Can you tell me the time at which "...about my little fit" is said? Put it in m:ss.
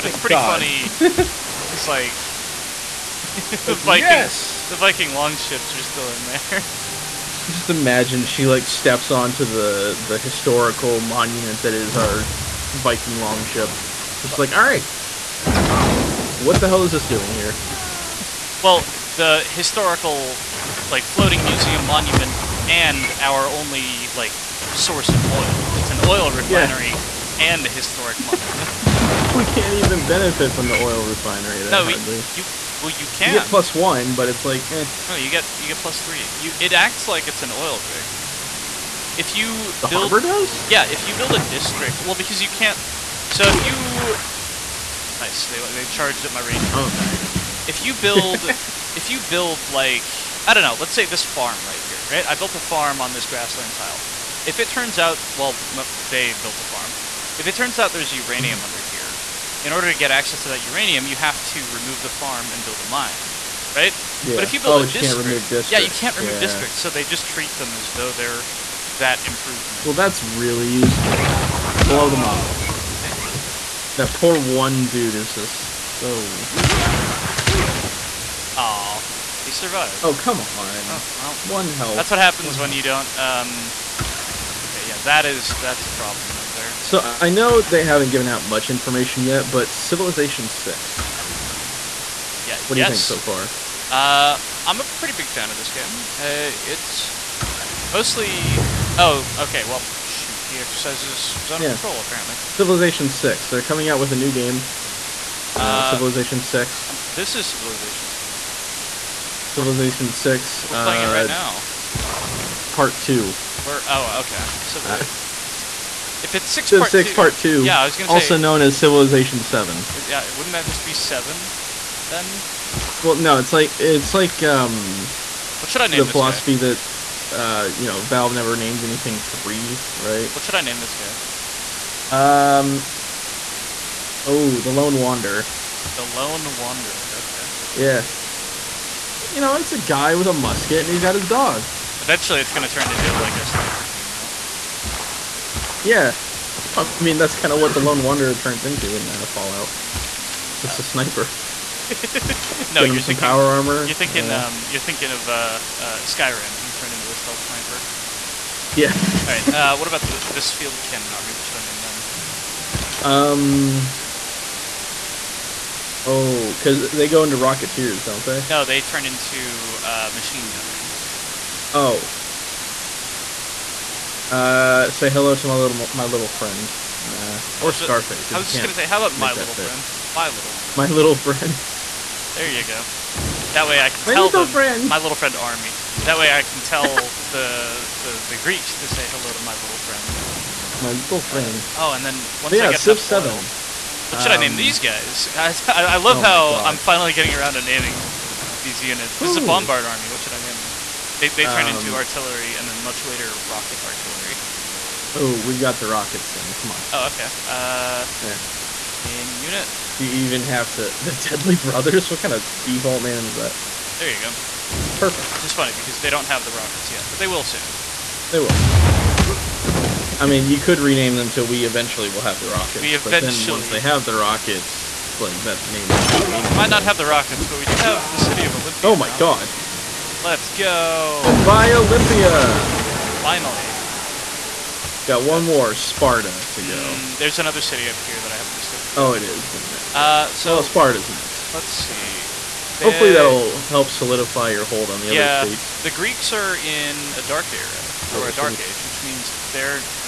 2:59.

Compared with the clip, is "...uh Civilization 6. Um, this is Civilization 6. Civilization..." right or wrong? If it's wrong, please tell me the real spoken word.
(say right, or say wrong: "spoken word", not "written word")
right.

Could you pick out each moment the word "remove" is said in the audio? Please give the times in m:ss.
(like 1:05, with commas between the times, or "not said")
1:01, 1:06.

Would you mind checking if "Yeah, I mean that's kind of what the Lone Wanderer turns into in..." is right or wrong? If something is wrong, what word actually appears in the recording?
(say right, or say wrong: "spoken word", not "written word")
right.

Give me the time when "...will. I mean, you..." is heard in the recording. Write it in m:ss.
3:38.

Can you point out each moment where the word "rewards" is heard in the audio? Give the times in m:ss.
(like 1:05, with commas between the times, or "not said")
not said.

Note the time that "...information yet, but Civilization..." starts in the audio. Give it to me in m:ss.
1:28.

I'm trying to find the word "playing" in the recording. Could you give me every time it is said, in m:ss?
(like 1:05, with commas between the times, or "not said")
1:50.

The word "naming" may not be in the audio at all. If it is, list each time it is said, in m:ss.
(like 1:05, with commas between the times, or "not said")
3:17.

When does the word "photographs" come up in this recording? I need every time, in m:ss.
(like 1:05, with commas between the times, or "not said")
not said.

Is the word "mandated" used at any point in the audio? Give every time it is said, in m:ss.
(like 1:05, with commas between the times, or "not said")
not said.